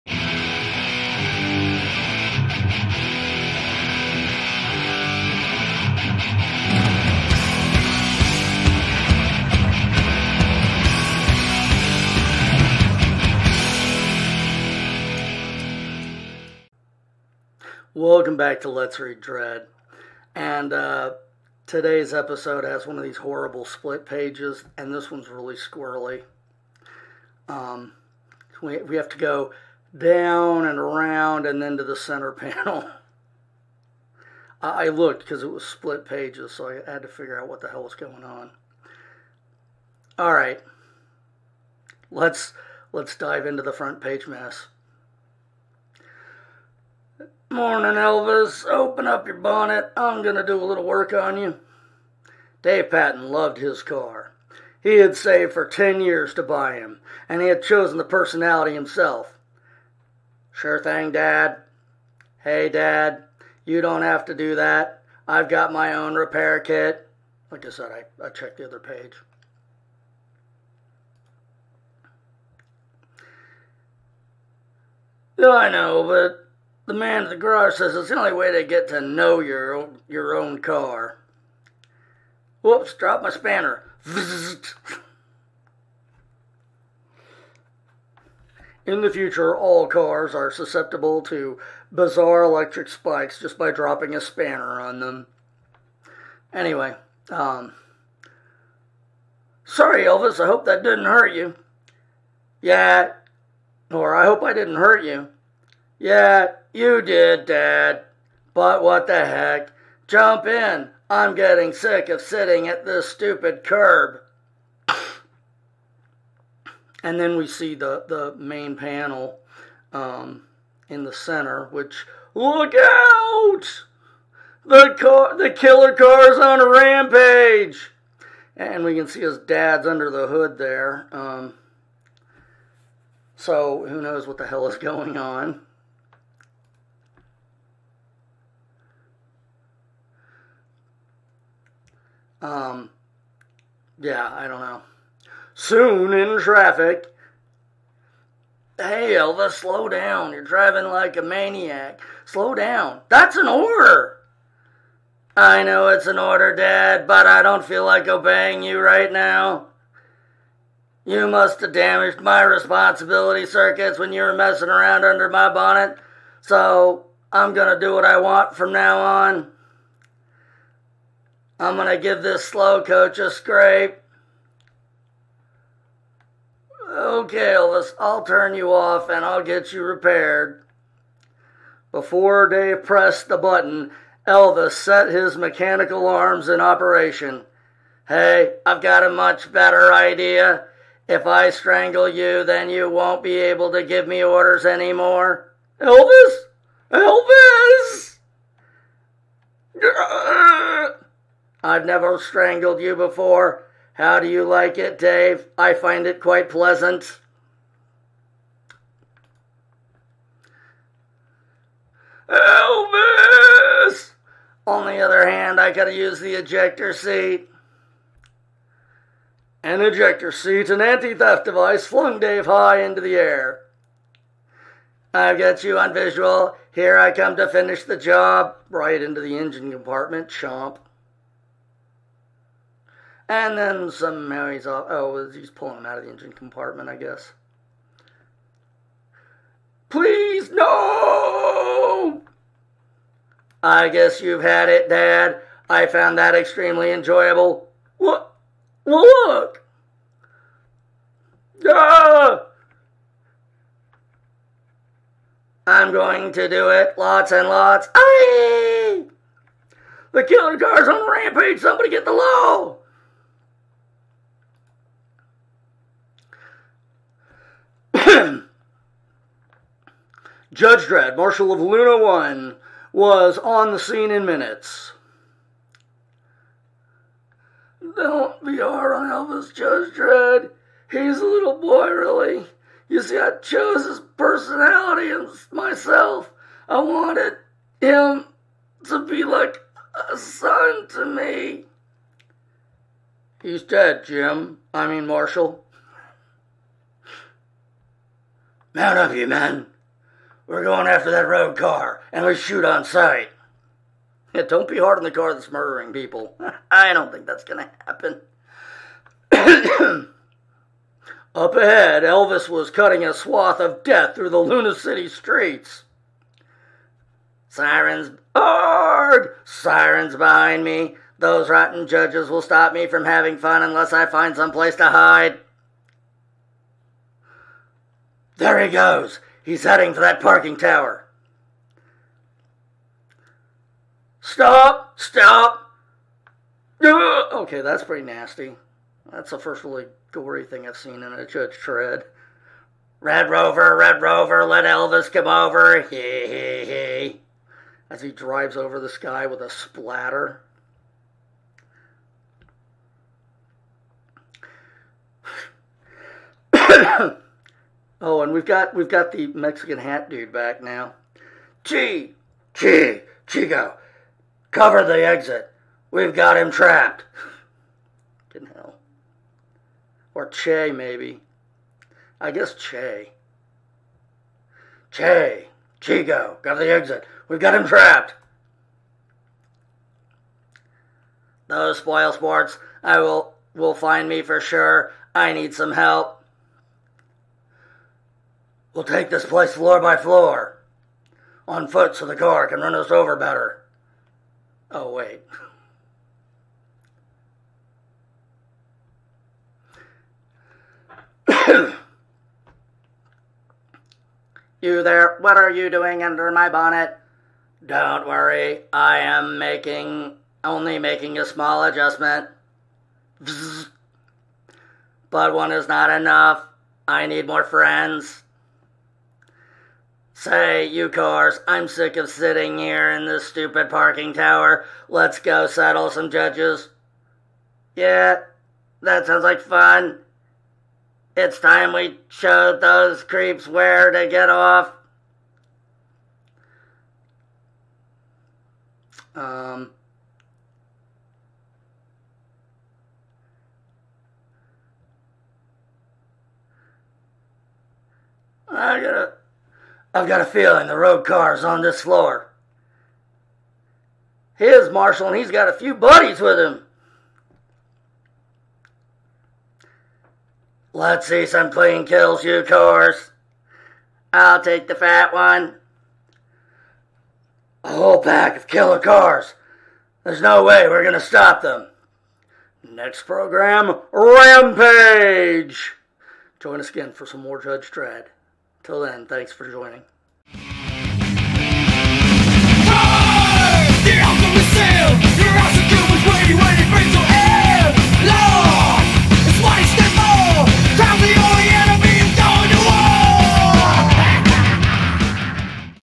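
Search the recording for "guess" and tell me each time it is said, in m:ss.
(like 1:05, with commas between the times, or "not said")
3:56, 4:03, 6:12.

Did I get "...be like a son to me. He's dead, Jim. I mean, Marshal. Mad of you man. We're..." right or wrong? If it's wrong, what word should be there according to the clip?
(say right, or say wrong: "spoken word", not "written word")
right.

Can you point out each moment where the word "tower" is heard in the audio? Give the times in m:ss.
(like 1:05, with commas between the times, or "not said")
5:30, 7:04.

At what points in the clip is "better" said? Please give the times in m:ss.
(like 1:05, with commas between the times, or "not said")
3:09, 6:33.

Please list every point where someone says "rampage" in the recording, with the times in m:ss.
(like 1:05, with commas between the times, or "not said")
2:06, 4:21, 7:53.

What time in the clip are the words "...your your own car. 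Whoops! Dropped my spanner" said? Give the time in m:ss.
1:19.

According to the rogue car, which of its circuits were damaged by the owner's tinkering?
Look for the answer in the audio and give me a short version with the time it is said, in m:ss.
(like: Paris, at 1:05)
Responsibility circuits, at 2:42.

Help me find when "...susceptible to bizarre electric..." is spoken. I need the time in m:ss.
1:30.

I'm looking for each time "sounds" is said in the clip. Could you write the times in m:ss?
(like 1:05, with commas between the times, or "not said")
7:09.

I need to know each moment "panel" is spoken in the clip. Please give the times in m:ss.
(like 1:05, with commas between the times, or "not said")
0:32, 1:58.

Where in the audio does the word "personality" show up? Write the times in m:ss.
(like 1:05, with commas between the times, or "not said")
0:58, 4:44.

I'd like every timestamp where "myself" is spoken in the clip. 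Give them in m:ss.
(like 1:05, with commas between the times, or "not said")
4:45.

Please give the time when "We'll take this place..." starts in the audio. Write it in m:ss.
6:28.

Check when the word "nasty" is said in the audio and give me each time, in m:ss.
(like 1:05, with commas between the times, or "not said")
5:38.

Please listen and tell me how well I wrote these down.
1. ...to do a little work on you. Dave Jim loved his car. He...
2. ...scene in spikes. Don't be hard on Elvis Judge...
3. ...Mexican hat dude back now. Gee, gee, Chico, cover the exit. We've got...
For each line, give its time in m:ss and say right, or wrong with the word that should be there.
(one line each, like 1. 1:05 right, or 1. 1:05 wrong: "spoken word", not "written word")
1. 0:50 wrong: "Patton", not "Jim"
2. 4:33 wrong: "minutes", not "spikes"
3. 5:59 right.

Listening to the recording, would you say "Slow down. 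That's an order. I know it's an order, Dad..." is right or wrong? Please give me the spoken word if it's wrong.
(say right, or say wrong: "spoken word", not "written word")
right.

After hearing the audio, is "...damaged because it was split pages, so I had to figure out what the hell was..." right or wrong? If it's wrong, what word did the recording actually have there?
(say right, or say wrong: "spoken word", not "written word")
wrong: "looked", not "damaged".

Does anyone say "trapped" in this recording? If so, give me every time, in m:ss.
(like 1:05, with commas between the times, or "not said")
6:06, 6:17.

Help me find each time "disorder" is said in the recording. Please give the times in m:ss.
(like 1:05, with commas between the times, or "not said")
not said.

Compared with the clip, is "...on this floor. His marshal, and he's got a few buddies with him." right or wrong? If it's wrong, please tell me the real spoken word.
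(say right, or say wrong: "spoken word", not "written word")
right.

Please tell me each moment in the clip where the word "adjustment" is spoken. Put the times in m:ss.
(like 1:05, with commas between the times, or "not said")
6:51.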